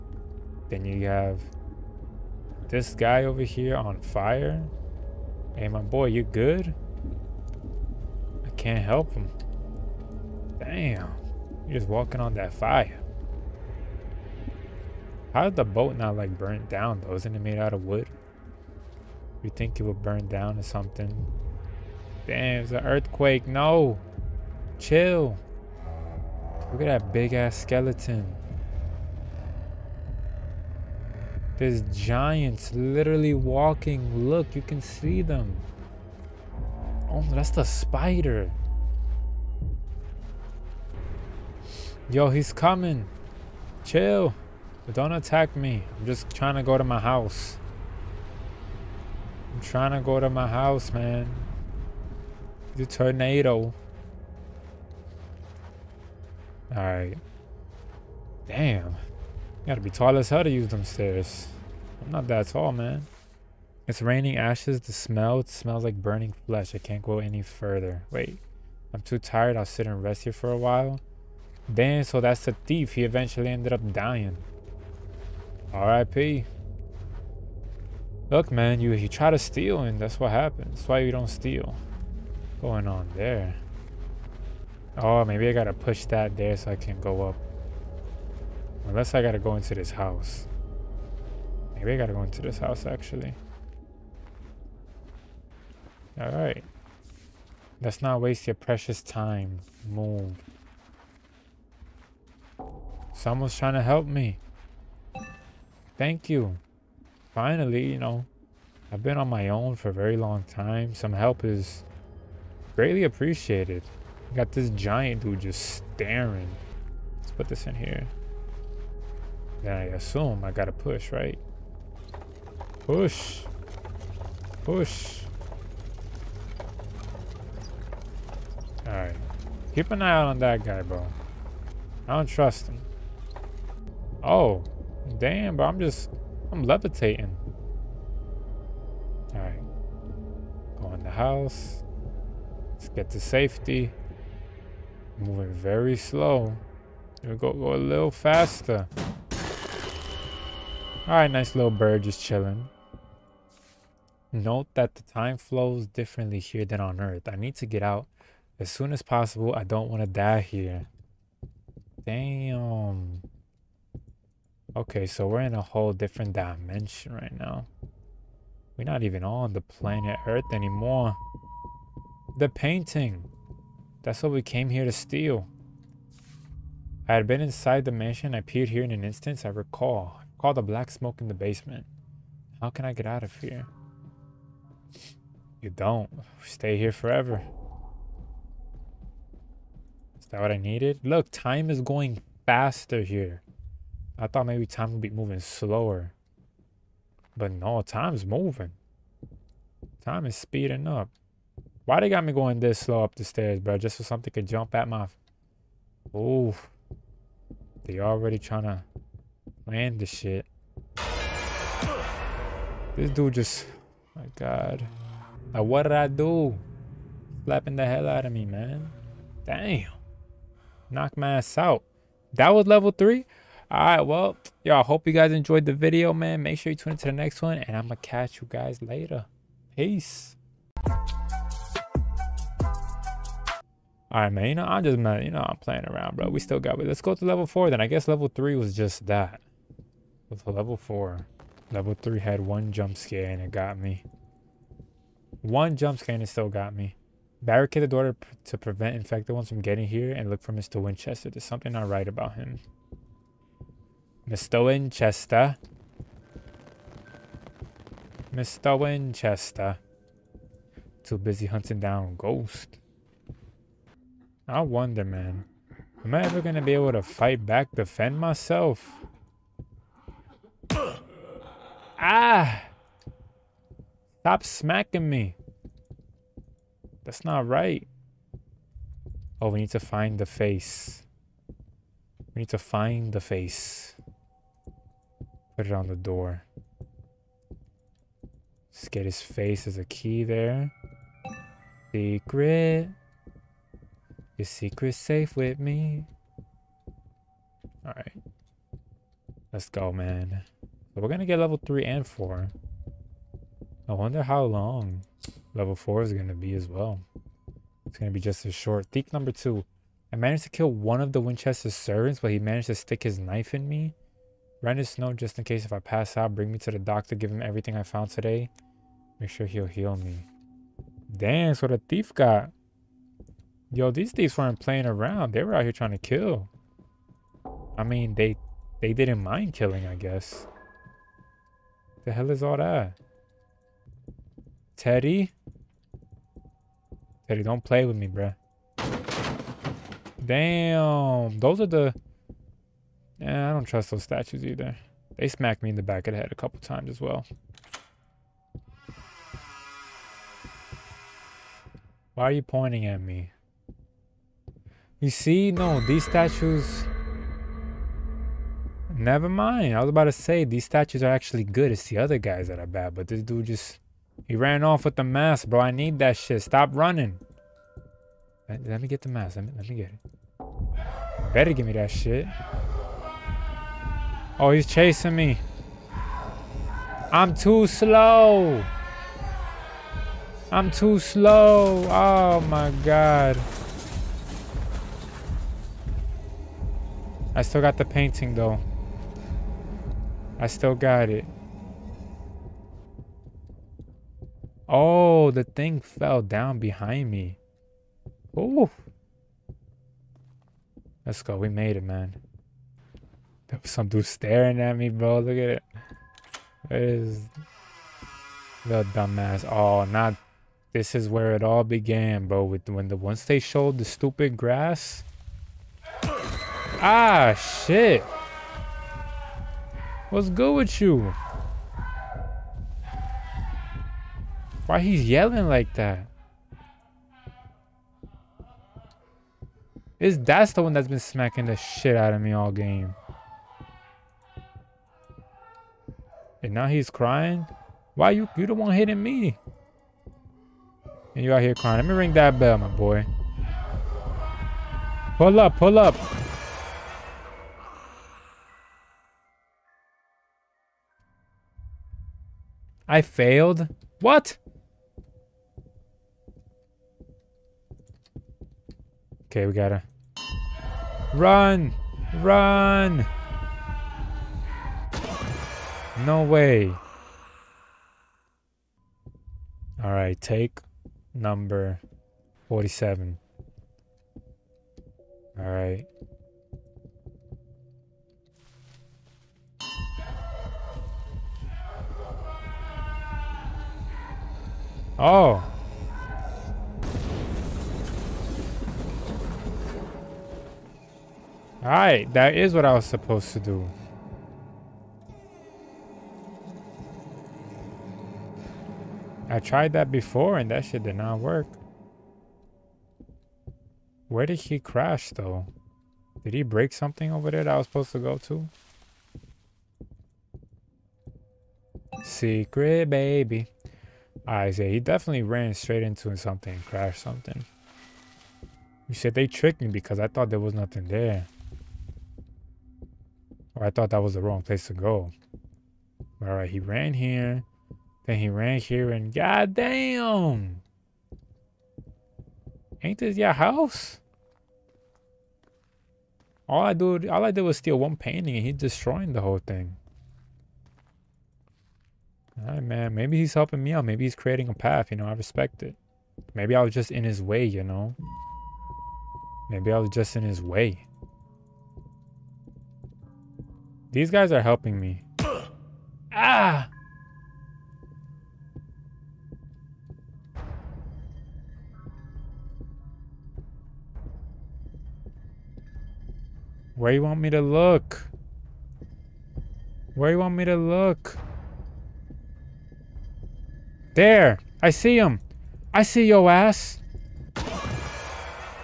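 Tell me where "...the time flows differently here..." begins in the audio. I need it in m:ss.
2:34.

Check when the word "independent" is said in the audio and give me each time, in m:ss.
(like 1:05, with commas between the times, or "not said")
not said.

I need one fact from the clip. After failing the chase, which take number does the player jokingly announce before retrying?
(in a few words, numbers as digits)
47.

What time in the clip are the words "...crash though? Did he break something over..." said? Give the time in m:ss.
8:24.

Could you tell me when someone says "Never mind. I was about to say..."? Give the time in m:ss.
5:58.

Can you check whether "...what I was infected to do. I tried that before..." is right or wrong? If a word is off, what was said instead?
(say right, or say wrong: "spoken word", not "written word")
wrong: "supposed", not "infected".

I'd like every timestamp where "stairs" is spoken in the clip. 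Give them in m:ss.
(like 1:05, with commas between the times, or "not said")
1:00, 3:23.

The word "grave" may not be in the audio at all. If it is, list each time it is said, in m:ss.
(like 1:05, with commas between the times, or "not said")
not said.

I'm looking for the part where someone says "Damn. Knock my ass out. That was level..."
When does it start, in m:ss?
3:39.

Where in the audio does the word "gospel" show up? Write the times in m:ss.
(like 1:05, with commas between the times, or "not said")
not said.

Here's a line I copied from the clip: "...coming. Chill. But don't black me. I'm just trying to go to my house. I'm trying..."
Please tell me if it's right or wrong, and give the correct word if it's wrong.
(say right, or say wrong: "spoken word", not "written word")
wrong: "attack", not "black".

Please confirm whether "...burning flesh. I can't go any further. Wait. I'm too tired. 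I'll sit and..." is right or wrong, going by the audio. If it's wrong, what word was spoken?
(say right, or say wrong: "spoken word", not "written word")
right.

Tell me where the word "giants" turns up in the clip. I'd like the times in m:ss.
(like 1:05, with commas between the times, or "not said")
0:31, 1:54.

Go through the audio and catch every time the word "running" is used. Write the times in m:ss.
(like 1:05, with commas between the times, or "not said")
6:06.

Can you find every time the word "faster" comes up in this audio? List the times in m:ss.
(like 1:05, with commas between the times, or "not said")
2:28, 3:12.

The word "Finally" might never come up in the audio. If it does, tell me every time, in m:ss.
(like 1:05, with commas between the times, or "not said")
1:47.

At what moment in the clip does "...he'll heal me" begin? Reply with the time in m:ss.
5:19.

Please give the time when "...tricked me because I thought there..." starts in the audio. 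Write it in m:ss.
8:39.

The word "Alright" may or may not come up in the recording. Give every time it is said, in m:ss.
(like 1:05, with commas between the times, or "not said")
0:56, 1:36, 2:08, 4:57, 8:46.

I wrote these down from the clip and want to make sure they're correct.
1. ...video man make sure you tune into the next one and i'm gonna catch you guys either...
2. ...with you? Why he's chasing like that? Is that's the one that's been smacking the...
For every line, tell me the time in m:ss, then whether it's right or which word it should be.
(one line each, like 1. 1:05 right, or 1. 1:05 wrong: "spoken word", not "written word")
1. 3:45 wrong: "later", not "either"
2. 7:00 wrong: "yelling", not "chasing".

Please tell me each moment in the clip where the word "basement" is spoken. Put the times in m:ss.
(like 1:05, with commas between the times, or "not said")
3:01.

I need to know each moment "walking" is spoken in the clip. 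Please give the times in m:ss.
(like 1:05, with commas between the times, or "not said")
0:11, 0:33.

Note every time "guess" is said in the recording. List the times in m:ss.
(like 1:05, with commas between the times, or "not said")
3:57, 5:29.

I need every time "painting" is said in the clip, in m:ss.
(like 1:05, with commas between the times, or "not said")
2:52, 6:27, 8:57.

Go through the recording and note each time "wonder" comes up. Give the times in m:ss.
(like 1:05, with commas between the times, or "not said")
4:24, 5:03.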